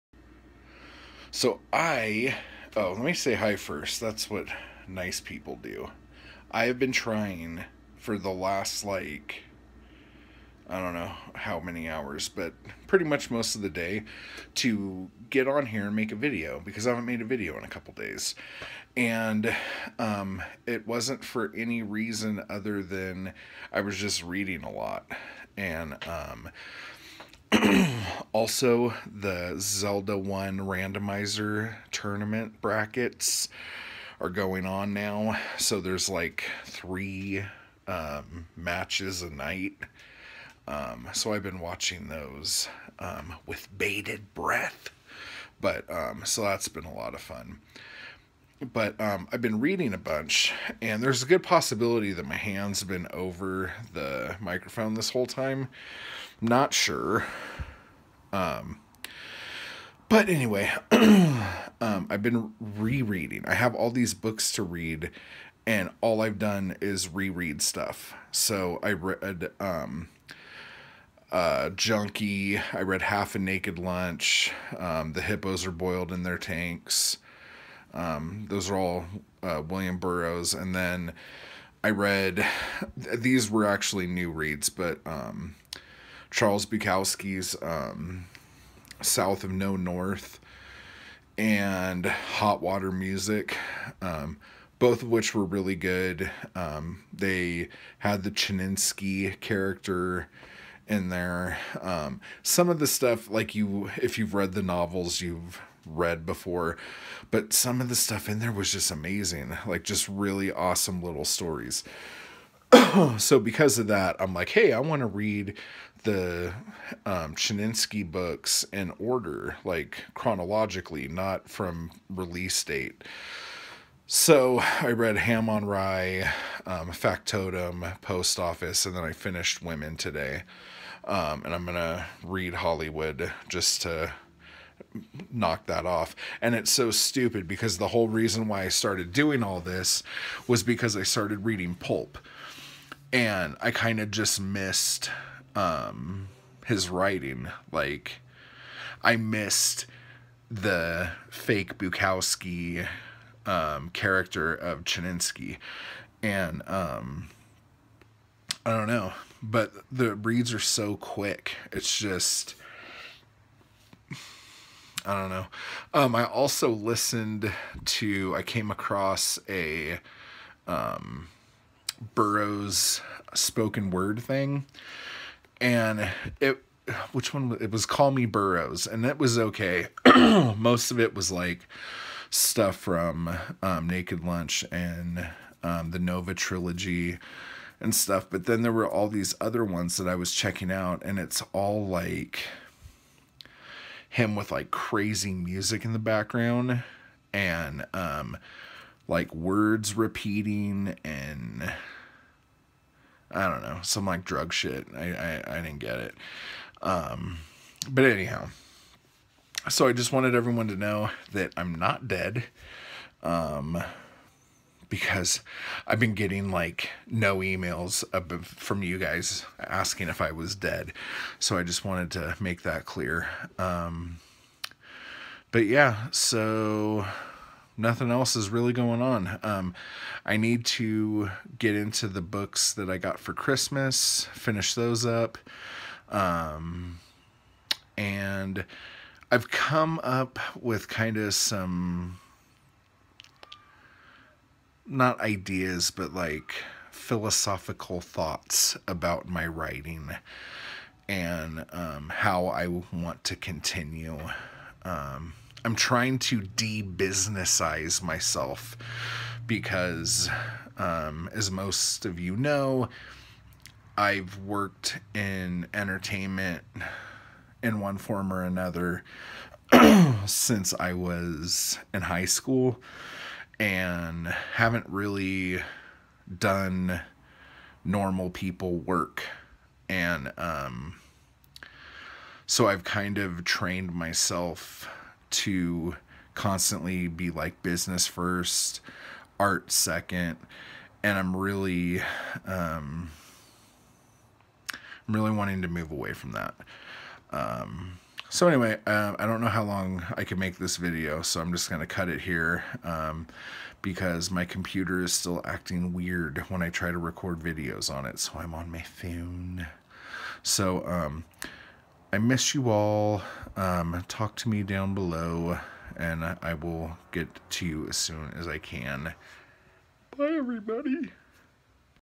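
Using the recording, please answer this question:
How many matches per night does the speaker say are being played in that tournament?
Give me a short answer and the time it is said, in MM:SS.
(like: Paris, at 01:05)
3, at 00:36.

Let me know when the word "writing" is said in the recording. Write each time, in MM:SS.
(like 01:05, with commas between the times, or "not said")
02:26, 04:09.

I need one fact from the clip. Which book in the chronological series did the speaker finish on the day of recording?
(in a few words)
Women.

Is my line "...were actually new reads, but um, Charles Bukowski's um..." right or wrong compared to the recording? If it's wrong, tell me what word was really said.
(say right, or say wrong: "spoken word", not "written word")
right.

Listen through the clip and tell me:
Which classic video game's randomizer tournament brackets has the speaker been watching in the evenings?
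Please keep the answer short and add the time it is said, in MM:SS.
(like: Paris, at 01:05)
Zelda 1, at 00:29.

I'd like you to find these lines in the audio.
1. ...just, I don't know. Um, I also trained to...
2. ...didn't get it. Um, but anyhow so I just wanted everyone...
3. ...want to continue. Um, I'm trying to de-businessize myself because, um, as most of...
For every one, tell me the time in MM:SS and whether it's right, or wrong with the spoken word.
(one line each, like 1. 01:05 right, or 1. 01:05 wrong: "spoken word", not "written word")
1. 02:41 wrong: "listened", not "trained"
2. 03:25 right
3. 04:12 right.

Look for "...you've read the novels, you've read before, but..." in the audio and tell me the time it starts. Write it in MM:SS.
01:44.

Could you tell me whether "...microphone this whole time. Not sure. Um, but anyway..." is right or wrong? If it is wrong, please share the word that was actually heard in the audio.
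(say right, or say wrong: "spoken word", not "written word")
right.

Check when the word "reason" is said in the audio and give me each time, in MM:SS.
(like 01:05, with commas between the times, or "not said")
00:21, 02:18.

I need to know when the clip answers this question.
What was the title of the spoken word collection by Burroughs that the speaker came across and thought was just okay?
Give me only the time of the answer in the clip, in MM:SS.
02:57.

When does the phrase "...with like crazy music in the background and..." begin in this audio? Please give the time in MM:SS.
03:14.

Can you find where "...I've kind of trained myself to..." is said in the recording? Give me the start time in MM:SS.
04:42.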